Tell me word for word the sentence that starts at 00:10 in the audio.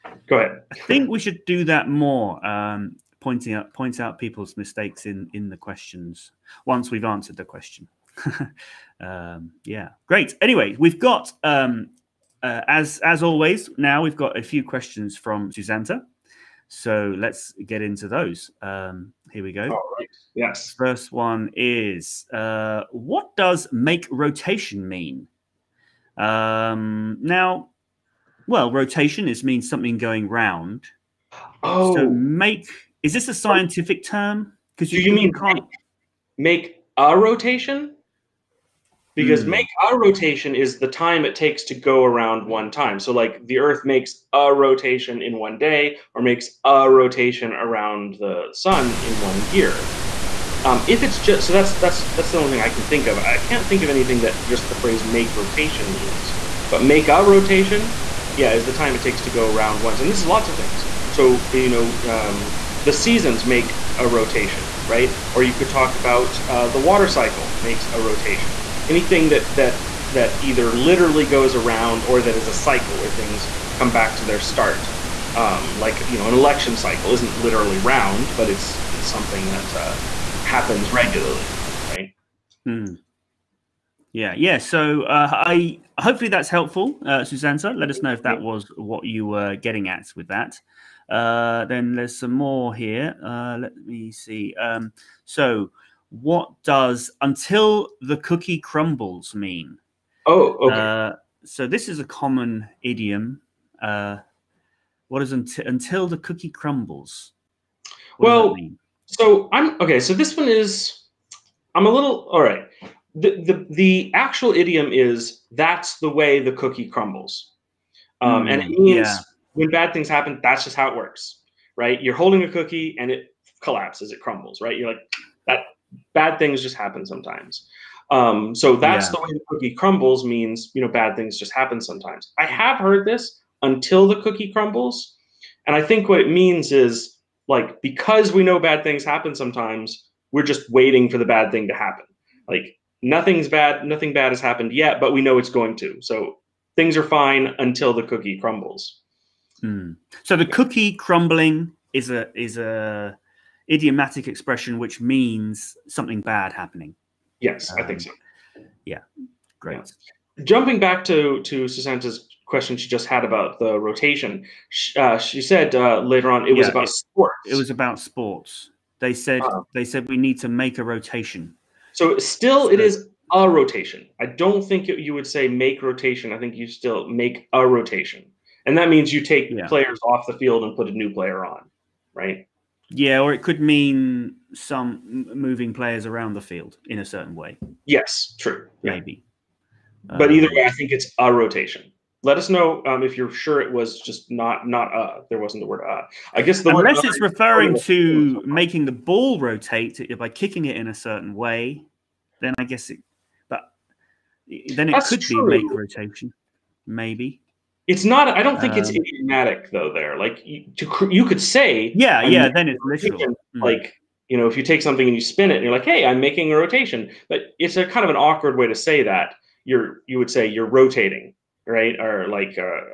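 Anyway, we've got um, uh, as as always.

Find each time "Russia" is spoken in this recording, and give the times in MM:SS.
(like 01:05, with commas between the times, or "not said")
not said.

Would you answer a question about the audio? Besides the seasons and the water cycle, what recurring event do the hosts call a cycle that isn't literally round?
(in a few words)
an election cycle.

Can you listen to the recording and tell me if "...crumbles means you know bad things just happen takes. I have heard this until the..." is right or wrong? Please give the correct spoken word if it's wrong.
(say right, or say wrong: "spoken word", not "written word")
wrong: "sometimes", not "takes".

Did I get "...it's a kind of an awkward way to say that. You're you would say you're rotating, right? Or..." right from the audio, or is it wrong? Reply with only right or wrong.
right.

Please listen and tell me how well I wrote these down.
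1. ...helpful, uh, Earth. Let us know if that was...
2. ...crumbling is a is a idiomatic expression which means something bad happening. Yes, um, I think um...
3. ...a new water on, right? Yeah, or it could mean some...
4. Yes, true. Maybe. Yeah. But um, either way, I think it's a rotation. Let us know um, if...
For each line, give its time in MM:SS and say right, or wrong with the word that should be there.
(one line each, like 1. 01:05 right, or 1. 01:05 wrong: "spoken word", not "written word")
1. 01:26 wrong: "Susanna", not "Earth"
2. 02:30 right
3. 03:00 wrong: "player", not "water"
4. 03:07 right.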